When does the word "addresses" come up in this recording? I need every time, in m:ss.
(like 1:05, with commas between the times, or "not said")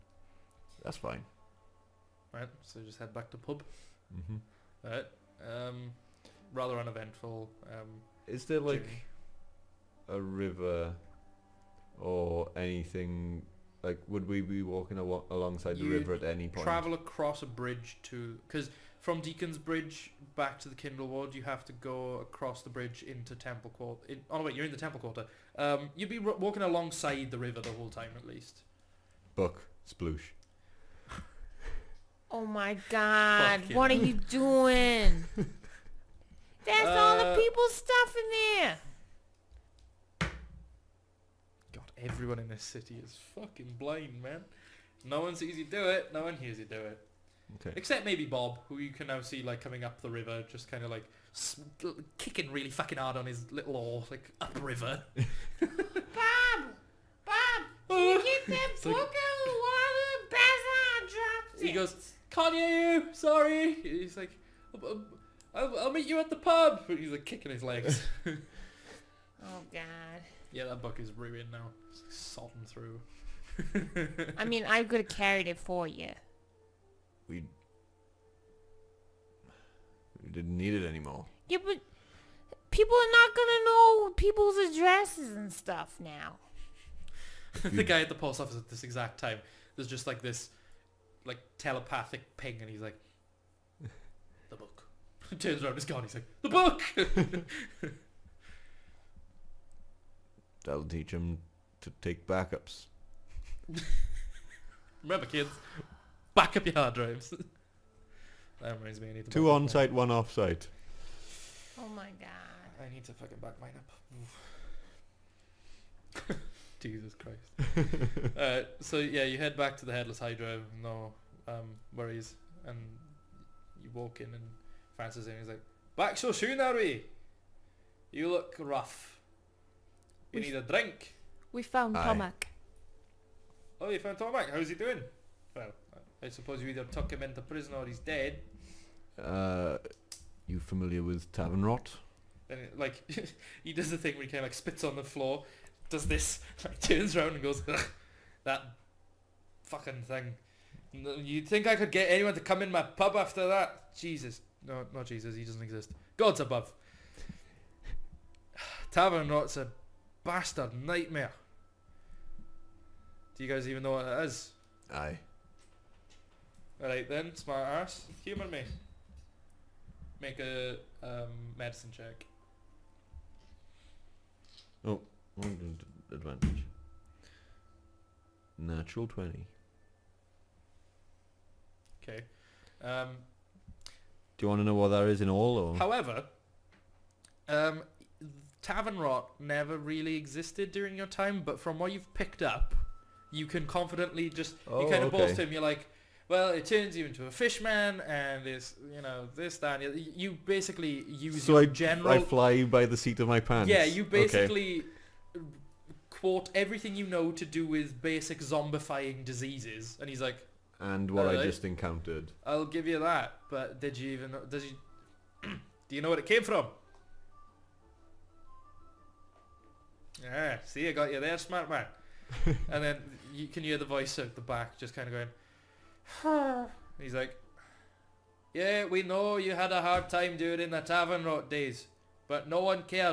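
1:24.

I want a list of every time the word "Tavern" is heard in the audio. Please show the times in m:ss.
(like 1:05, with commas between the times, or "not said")
2:21, 2:38, 3:08, 3:50.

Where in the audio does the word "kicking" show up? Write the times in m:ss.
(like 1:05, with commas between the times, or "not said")
0:52, 1:07.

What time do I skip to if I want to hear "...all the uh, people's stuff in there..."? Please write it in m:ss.
0:36.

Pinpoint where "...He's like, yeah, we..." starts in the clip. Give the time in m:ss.
3:47.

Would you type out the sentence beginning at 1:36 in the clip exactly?
He's like, "The book." That'll teach him to take backups.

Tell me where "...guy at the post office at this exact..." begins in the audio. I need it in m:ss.
1:27.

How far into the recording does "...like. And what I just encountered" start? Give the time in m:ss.
3:30.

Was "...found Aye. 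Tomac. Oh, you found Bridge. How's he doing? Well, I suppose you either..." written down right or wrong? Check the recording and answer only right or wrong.
wrong.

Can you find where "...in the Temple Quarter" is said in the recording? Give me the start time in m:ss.
0:24.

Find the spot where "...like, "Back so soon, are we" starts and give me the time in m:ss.
2:05.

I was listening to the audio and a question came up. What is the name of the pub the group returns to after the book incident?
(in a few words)
Headless Hydro.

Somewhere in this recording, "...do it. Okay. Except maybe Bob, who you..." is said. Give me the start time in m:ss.
0:46.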